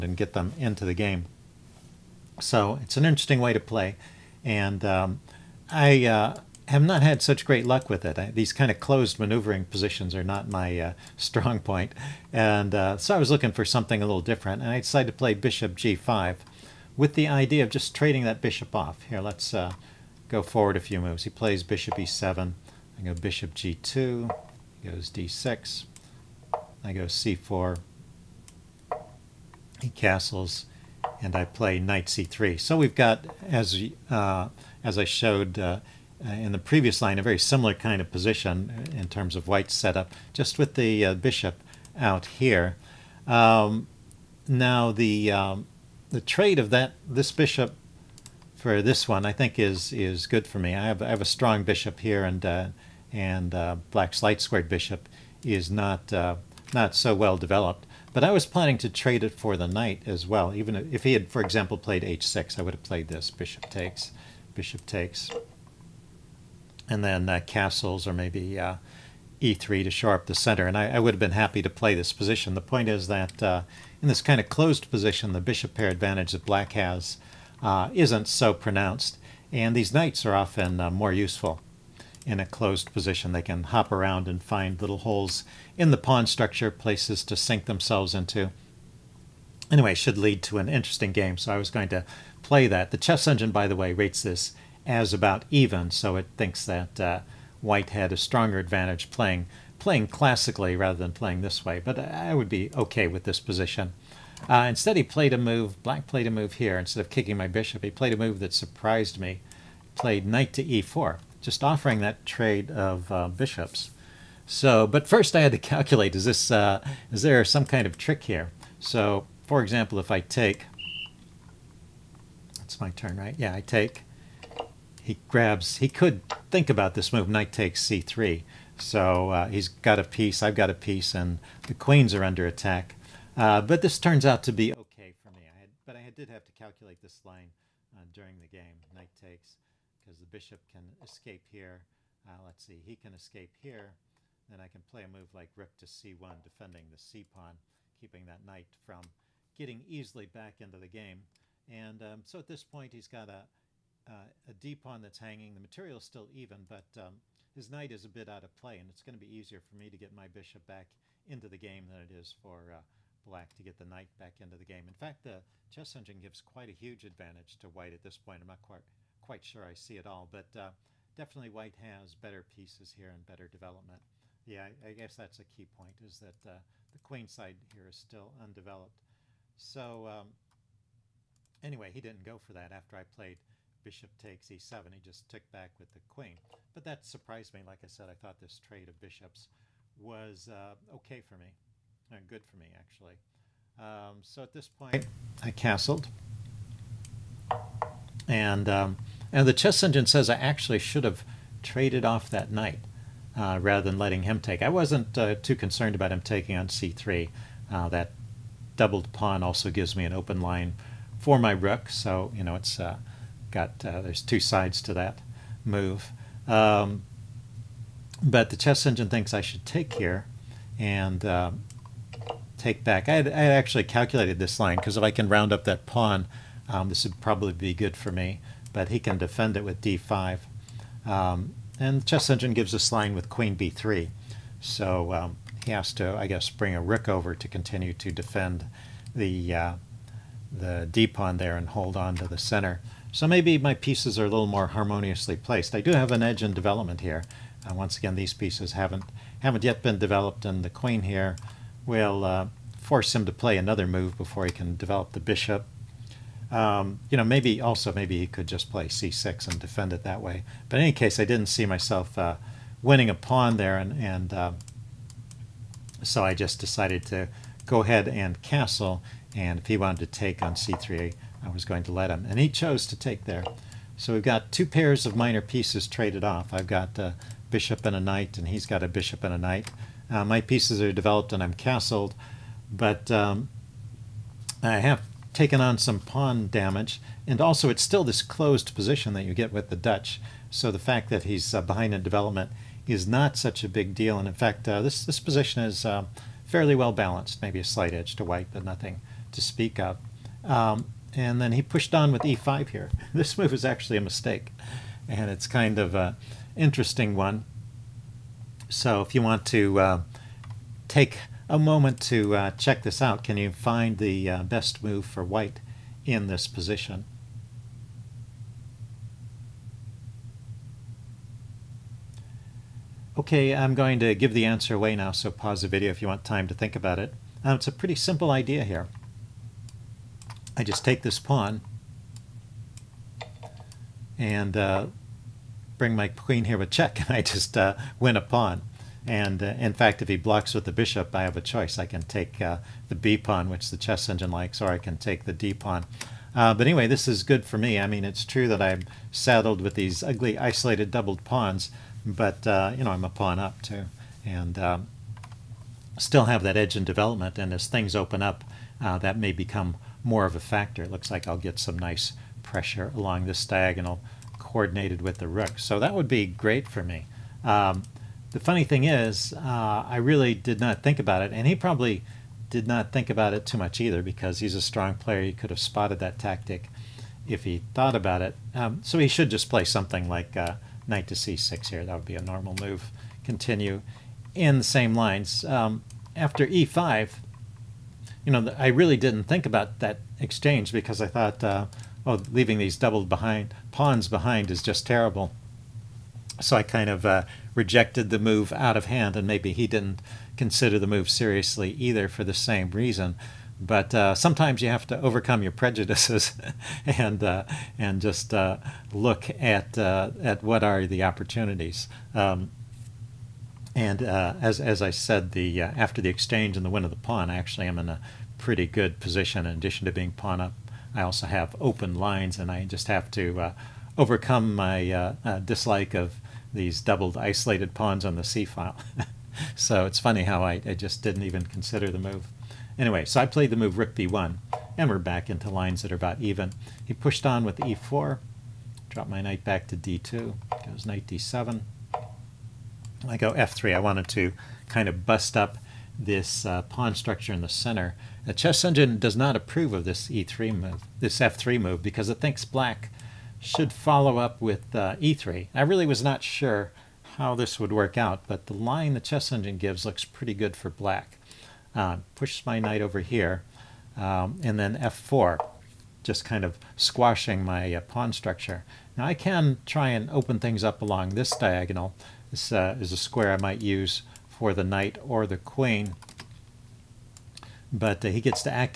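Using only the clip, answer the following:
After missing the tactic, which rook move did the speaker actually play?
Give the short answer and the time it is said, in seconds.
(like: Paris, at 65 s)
Rook b1, at 433 s.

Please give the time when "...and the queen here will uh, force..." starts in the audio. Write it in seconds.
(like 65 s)
250 s.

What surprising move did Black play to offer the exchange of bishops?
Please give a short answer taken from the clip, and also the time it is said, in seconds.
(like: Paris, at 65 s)
Knight to e4, at 110 s.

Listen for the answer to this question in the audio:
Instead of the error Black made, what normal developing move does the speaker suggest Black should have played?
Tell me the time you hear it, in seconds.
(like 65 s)
380 s.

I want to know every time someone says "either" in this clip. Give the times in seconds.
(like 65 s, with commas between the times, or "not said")
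373 s, 401 s.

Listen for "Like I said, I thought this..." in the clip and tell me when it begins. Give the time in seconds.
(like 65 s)
187 s.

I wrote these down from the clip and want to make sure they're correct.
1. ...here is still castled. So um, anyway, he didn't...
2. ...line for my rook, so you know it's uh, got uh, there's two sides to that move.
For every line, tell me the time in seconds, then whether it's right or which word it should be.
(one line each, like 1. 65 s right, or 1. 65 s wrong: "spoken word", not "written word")
1. 177 s wrong: "undeveloped", not "castled"
2. 210 s right.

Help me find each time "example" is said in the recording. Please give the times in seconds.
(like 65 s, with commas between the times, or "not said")
61 s, 119 s.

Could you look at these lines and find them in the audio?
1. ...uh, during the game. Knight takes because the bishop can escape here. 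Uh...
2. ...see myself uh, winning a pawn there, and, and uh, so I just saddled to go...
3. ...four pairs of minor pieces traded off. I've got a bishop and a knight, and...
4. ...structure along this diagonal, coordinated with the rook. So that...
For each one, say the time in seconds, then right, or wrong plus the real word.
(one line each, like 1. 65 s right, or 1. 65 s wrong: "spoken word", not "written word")
1. 137 s right
2. 261 s wrong: "decided", not "saddled"
3. 274 s wrong: "two", not "four"
4. 362 s wrong: "pressure", not "structure".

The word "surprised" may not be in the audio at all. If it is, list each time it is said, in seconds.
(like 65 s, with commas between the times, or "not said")
108 s, 187 s.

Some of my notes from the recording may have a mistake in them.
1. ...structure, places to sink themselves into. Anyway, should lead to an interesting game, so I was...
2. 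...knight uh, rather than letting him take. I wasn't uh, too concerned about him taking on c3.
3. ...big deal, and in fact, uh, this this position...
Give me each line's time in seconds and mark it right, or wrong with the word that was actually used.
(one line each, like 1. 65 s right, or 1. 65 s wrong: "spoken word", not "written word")
1. 86 s right
2. 202 s right
3. 293 s right.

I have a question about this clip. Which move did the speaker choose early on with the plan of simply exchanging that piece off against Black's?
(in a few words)
Bishop g5.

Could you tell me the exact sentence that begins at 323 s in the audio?
Okay, I'm going to give the answer away now, so pause the video if you want time to think about it.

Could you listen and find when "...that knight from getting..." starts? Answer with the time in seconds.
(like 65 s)
148 s.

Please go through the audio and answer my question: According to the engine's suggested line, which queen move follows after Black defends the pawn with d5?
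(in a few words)
Queen b3.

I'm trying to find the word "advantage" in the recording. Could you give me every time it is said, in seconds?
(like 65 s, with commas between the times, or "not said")
75 s, 98 s, 167 s.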